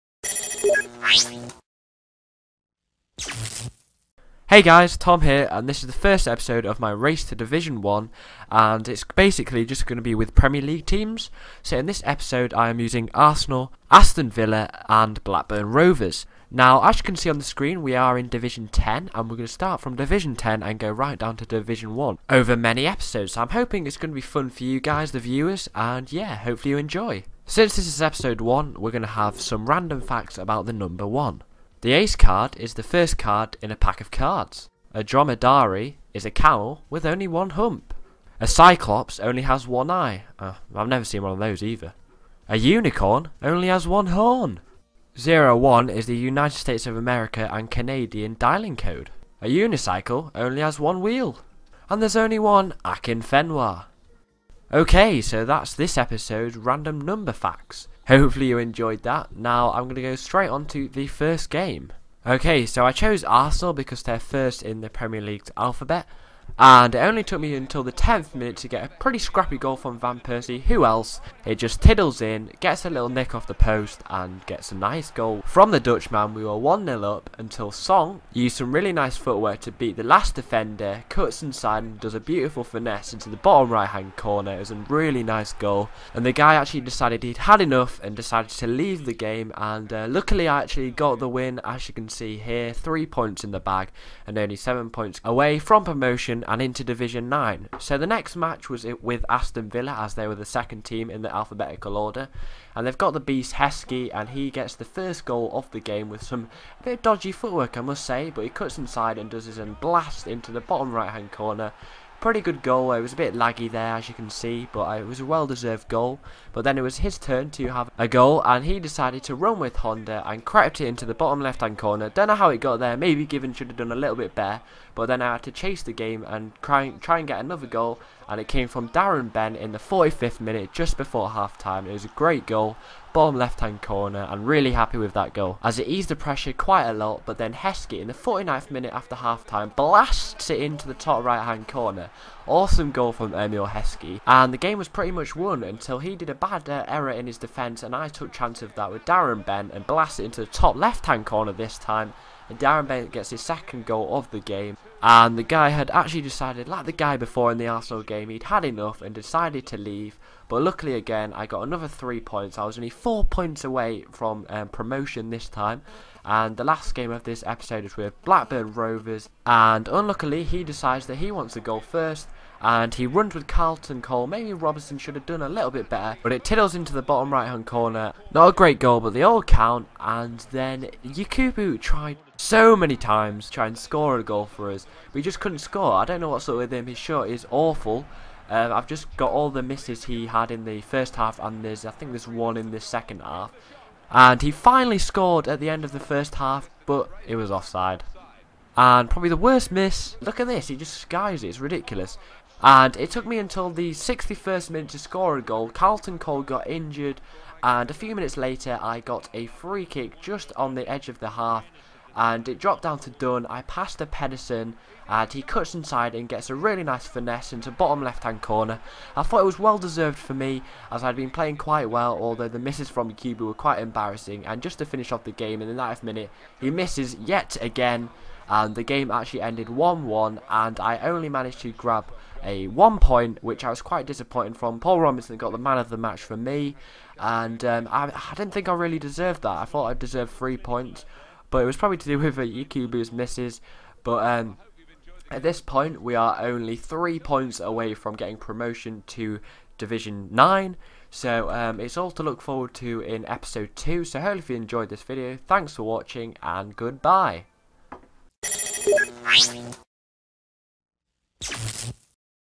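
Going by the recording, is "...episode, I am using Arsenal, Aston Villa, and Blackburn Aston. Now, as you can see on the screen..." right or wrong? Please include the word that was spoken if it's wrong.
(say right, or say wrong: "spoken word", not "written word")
wrong: "Rovers", not "Aston".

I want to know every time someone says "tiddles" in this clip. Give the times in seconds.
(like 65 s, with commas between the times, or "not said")
71 s, 176 s.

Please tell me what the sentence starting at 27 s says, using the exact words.
Since this is episode 1, we're going to have some random facts about the number 1.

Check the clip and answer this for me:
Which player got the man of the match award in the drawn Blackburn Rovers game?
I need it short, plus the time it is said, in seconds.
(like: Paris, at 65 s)
Paul Robinson, at 234 s.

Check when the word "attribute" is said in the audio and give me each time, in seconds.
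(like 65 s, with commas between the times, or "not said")
not said.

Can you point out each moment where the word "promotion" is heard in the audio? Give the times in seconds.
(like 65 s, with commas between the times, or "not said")
95 s, 164 s, 248 s.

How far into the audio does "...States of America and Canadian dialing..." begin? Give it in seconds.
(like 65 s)
46 s.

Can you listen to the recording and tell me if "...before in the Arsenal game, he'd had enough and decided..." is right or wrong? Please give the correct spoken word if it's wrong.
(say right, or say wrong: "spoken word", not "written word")
right.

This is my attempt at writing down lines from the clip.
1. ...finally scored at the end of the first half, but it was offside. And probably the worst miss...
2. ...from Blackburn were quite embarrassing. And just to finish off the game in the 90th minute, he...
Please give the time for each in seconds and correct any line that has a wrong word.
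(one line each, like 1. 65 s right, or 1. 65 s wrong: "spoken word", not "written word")
1. 194 s right
2. 222 s wrong: "Yakubu", not "Blackburn".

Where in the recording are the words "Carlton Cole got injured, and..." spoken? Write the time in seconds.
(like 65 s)
205 s.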